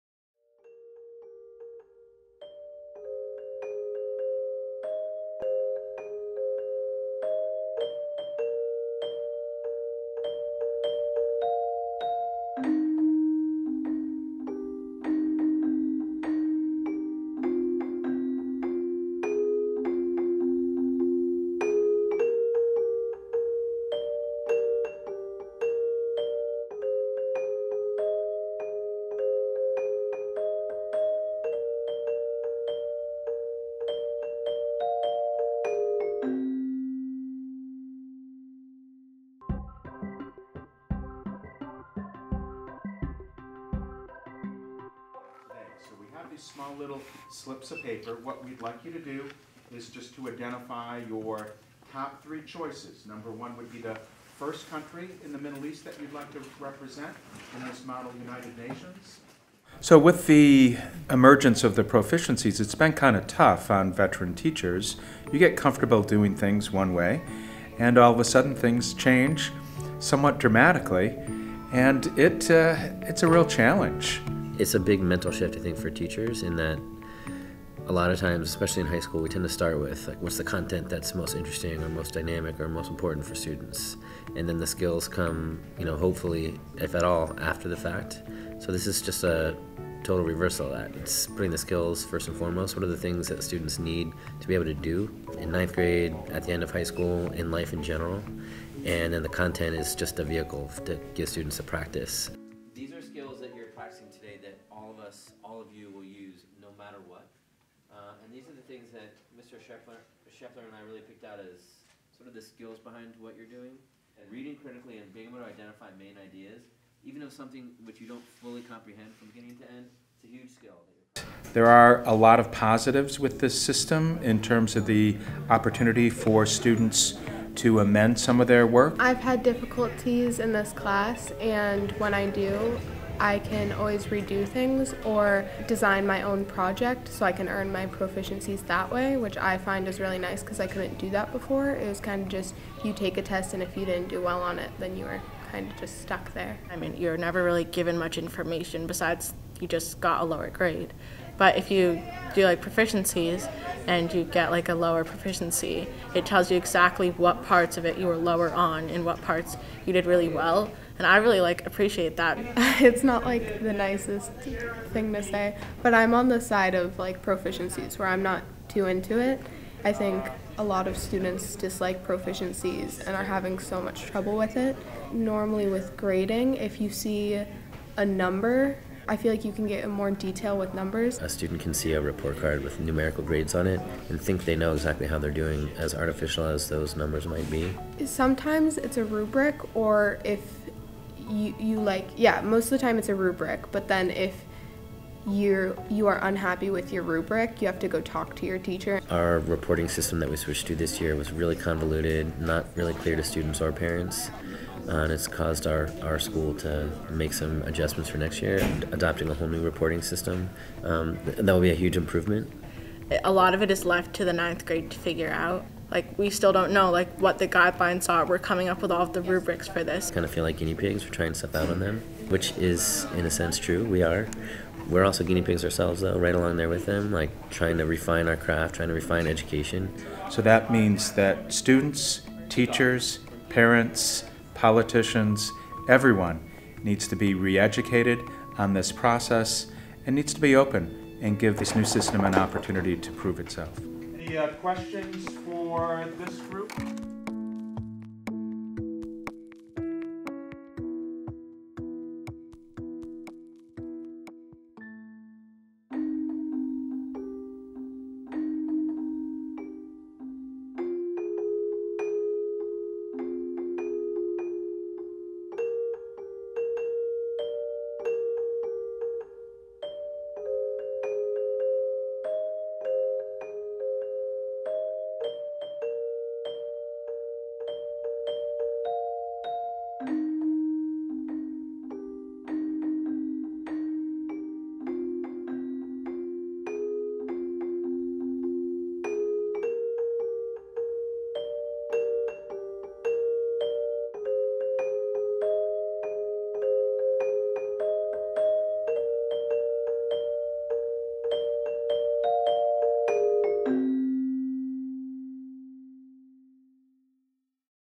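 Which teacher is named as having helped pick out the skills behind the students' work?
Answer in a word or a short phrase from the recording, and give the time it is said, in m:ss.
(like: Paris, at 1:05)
Mr. Scheffler, at 1:49.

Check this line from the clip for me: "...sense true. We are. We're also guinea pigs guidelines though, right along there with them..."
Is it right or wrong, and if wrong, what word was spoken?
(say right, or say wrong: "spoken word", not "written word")
wrong: "ourselves", not "guidelines".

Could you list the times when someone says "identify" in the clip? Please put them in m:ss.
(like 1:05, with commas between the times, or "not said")
0:50, 1:55.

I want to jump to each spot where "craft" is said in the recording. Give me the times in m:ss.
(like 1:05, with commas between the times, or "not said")
3:48.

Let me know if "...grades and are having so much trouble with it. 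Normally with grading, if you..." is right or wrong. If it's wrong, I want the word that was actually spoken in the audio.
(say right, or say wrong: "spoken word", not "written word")
wrong: "proficiencies", not "grades".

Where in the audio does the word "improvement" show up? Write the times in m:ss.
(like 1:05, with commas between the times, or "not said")
3:31.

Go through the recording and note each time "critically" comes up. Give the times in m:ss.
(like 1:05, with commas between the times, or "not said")
1:54.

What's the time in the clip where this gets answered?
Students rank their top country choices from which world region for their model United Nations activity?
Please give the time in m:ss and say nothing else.
0:55.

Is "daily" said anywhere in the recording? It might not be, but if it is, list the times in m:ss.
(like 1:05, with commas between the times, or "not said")
not said.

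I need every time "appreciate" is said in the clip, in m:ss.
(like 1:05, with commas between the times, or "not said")
2:41.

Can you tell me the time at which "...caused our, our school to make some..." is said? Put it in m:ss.
3:25.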